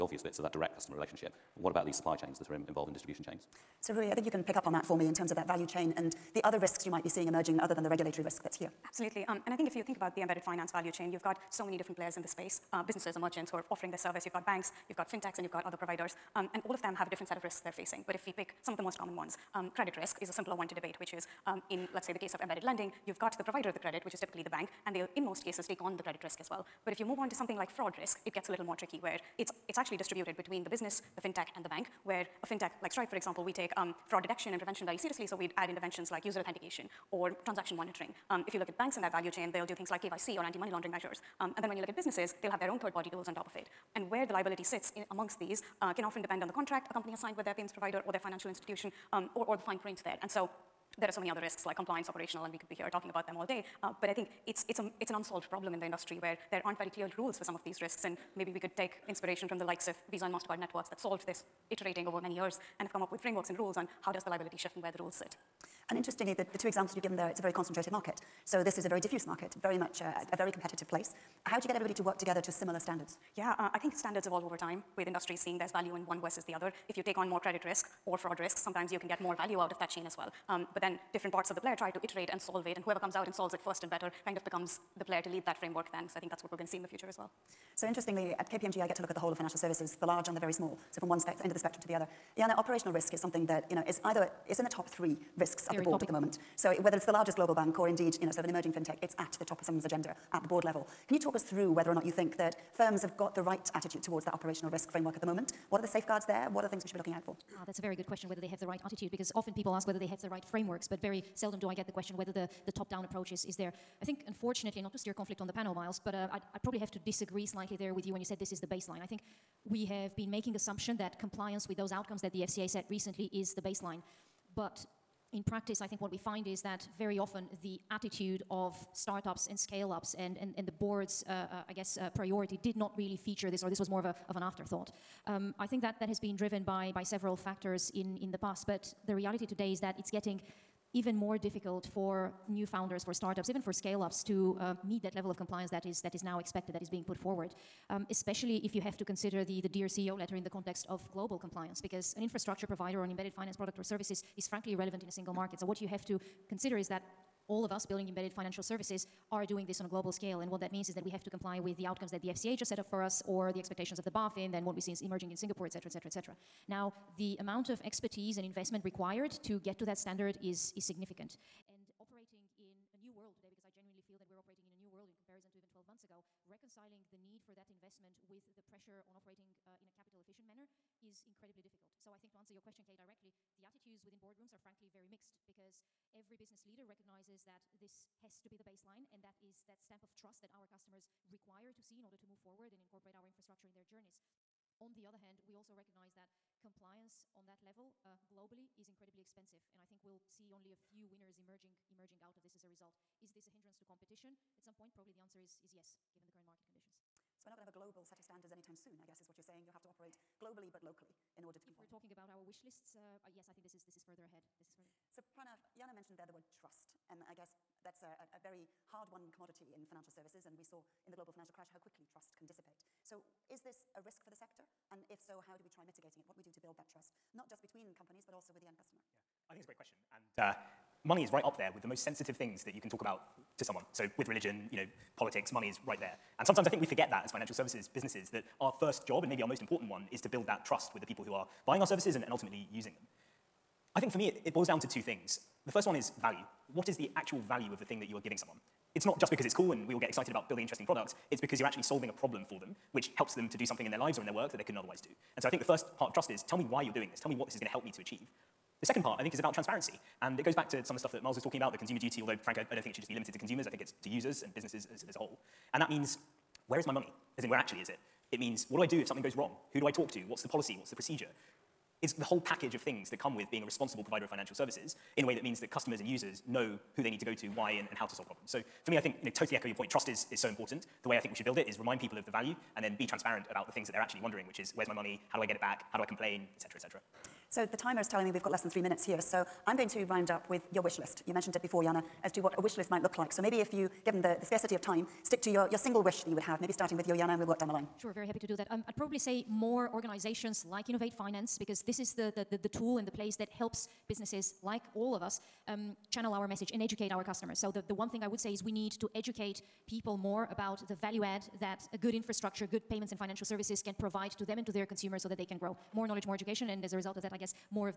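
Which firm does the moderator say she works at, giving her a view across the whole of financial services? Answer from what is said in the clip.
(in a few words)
KPMG.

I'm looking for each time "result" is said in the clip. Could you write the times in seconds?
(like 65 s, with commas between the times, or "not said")
202 s, 316 s.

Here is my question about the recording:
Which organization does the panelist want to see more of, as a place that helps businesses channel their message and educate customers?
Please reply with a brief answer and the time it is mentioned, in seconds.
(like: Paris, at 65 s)
Innovate Finance, at 300 s.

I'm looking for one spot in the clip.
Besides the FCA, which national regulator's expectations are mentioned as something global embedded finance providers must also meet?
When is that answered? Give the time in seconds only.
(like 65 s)
164 s.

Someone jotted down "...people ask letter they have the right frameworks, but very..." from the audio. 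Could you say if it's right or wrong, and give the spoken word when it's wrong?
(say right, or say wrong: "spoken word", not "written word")
wrong: "whether", not "letter".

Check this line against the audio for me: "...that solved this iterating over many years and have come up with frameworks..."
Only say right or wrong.
right.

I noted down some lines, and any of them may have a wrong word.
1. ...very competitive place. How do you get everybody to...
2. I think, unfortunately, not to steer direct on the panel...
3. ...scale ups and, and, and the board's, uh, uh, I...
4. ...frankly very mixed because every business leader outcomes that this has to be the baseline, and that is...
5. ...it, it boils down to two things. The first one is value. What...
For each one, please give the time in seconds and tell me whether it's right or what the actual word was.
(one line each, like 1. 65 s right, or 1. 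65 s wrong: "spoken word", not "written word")
1. 70 s right
2. 114 s wrong: "conflict", not "direct"
3. 129 s right
4. 184 s wrong: "recognizes", not "outcomes"
5. 244 s right.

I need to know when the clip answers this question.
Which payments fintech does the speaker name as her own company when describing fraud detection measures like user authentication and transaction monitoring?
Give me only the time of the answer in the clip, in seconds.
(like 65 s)
32 s.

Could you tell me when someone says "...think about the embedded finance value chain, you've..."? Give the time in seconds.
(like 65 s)
9 s.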